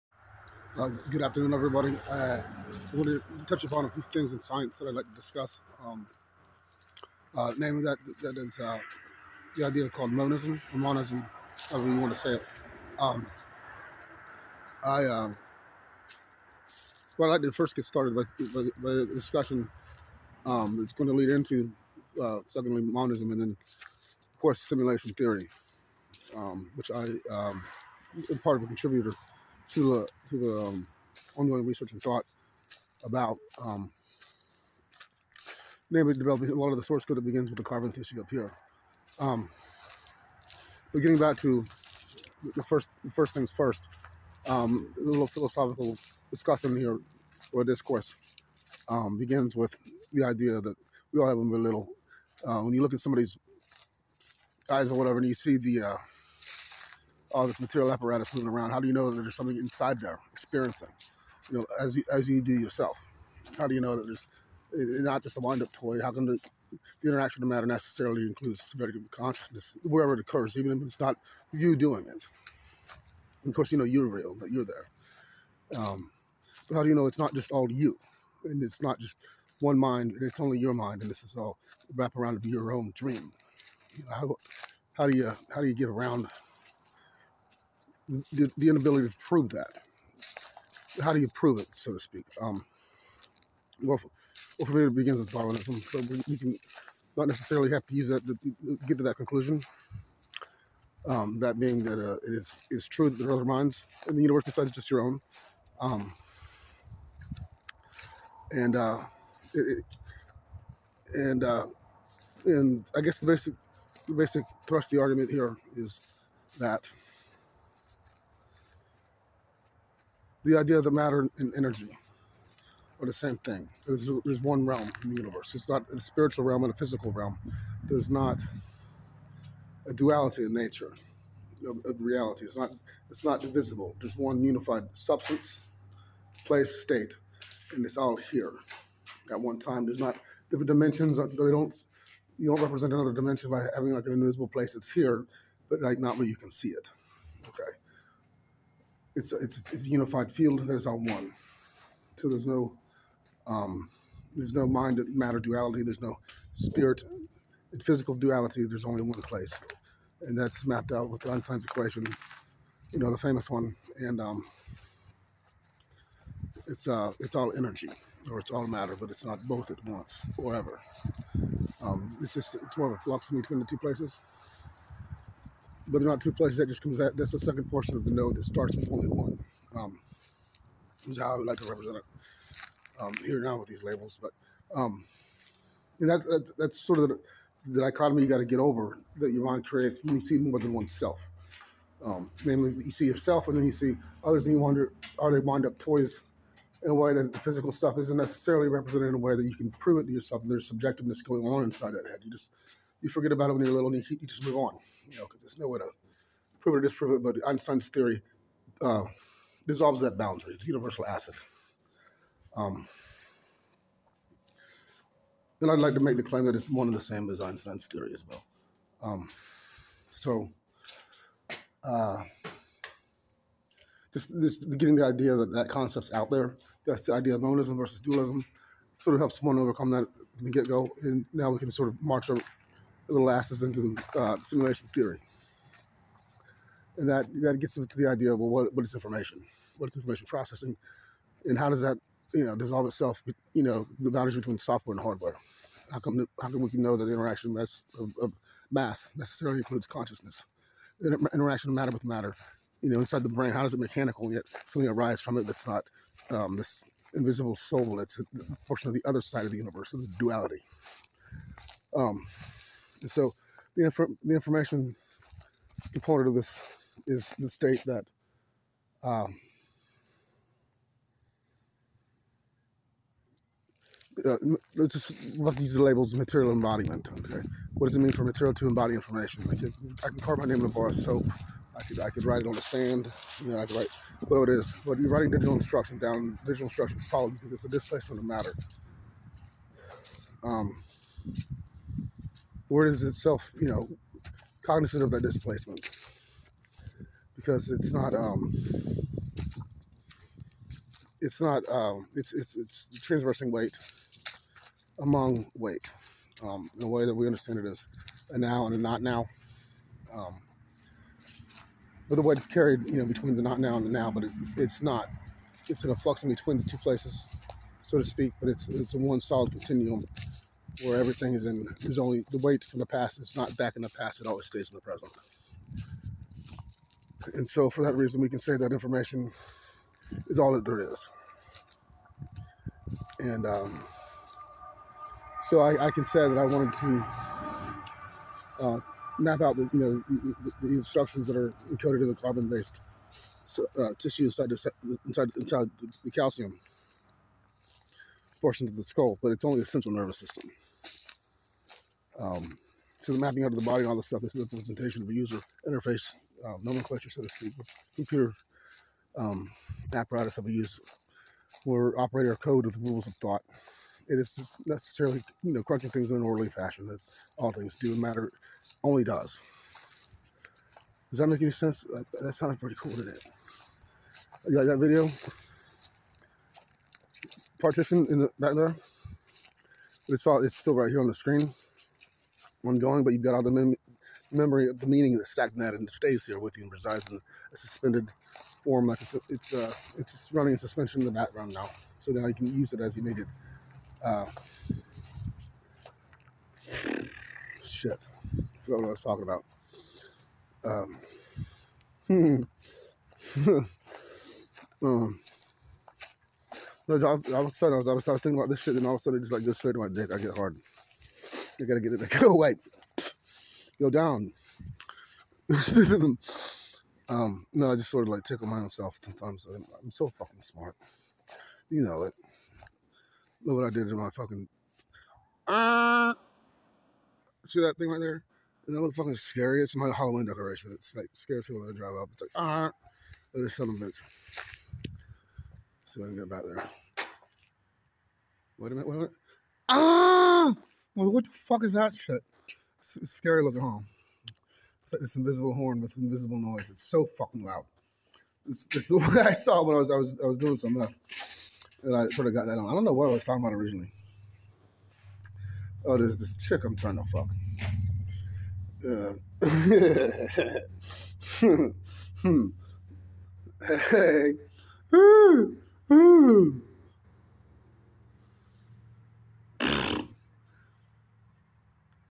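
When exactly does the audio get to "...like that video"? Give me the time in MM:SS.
06:14.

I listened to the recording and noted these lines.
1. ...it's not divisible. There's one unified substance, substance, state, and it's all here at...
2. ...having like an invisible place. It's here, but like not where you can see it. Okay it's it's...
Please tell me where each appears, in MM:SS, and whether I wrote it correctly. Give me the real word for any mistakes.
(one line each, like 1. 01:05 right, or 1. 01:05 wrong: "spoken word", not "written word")
1. 02:13 wrong: "place", not "substance"
2. 02:23 right.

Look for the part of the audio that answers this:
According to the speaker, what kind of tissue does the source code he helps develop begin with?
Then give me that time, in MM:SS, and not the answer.
00:37.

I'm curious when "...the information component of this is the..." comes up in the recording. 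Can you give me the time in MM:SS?
04:24.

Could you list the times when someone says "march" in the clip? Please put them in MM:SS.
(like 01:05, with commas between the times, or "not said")
03:52.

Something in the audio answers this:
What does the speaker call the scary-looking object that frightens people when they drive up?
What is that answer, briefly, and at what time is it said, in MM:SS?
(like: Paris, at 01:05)
Halloween decoration, at 07:09.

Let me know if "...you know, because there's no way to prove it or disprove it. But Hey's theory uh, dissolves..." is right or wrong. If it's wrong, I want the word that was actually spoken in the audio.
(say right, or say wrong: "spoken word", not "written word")
wrong: "Einstein", not "Hey".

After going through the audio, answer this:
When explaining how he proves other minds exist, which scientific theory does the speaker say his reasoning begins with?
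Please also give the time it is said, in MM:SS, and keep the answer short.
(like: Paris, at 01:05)
Darwinism, at 01:35.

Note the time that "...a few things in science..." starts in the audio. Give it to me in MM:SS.
00:03.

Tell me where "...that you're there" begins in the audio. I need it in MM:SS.
01:14.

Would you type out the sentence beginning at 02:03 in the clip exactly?
There's, there's one realm in the universe.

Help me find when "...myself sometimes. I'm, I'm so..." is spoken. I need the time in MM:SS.
06:58.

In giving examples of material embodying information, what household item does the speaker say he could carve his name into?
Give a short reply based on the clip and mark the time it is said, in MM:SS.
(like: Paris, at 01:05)
a bar of soap, at 04:40.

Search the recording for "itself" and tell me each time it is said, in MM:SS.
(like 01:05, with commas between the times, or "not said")
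04:02, 04:53.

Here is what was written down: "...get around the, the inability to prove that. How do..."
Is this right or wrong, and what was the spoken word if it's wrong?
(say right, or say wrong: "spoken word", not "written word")
right.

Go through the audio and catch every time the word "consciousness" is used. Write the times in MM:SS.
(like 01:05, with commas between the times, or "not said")
01:09, 04:09.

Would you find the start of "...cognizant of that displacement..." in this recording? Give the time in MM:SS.
04:54.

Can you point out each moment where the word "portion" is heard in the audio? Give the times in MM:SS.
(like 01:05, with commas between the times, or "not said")
02:57, 04:18, 05:48.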